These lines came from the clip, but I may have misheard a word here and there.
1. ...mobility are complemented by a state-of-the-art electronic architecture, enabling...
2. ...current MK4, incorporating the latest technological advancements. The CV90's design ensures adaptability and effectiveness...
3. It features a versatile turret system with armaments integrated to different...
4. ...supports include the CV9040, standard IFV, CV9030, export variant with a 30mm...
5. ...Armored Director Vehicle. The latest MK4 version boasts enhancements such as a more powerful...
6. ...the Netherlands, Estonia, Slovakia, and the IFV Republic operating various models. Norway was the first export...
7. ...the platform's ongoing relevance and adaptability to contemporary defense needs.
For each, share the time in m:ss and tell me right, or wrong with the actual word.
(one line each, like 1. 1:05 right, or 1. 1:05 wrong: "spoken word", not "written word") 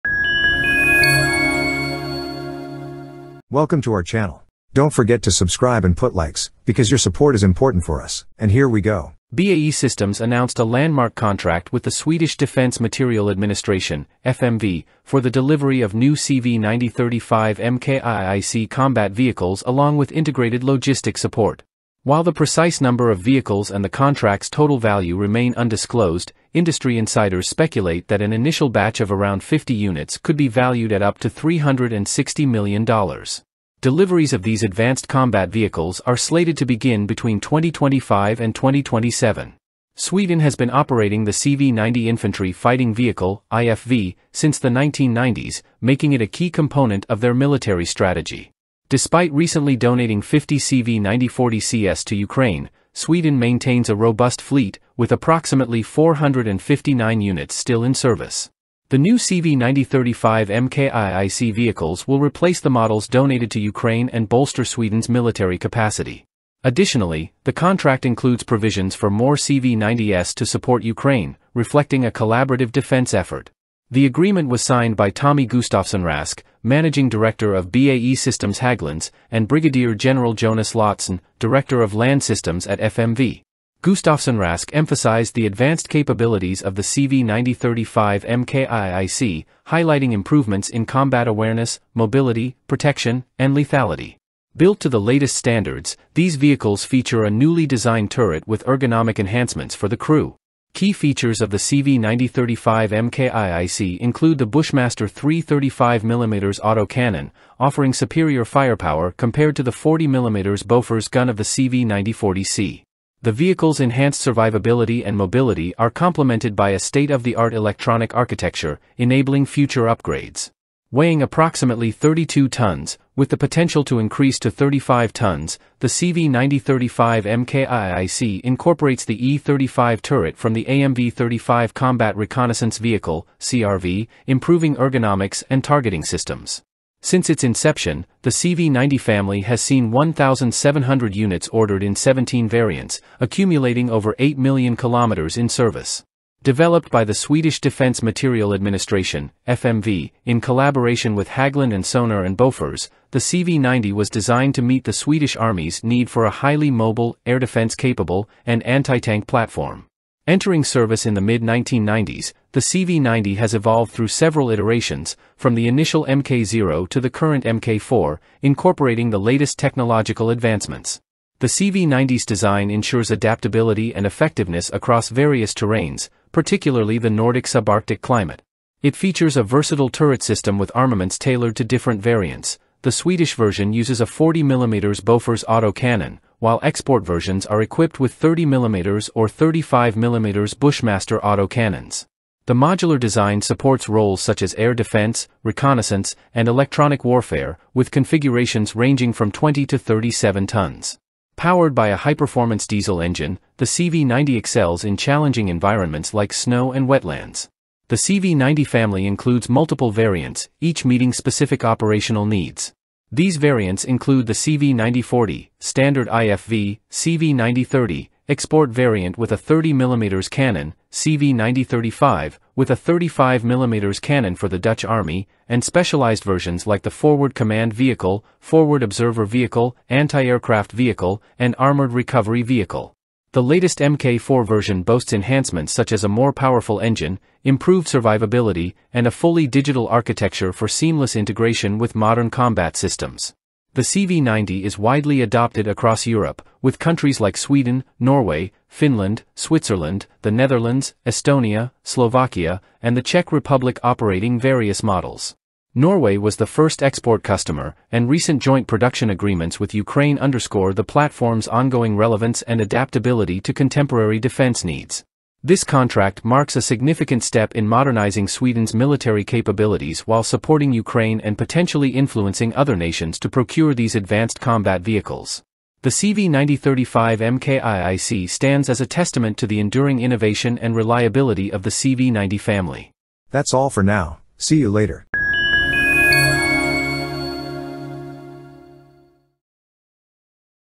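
1. 1:55 right
2. 2:47 right
3. 2:58 wrong: "tailored", not "integrated"
4. 3:33 wrong: "variants", not "supports"
5. 3:51 wrong: "Recovery", not "Director"
6. 4:10 wrong: "Czech", not "IFV"
7. 4:20 right.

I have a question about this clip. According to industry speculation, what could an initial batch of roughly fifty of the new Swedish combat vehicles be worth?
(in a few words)
$360 million.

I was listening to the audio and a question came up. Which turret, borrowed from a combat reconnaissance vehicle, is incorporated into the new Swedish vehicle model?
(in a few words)
E35.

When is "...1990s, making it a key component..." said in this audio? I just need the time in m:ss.
0:44.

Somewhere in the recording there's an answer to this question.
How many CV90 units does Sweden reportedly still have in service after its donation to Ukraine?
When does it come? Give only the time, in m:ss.
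0:55.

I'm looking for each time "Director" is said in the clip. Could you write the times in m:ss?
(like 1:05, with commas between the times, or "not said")
1:17, 1:21.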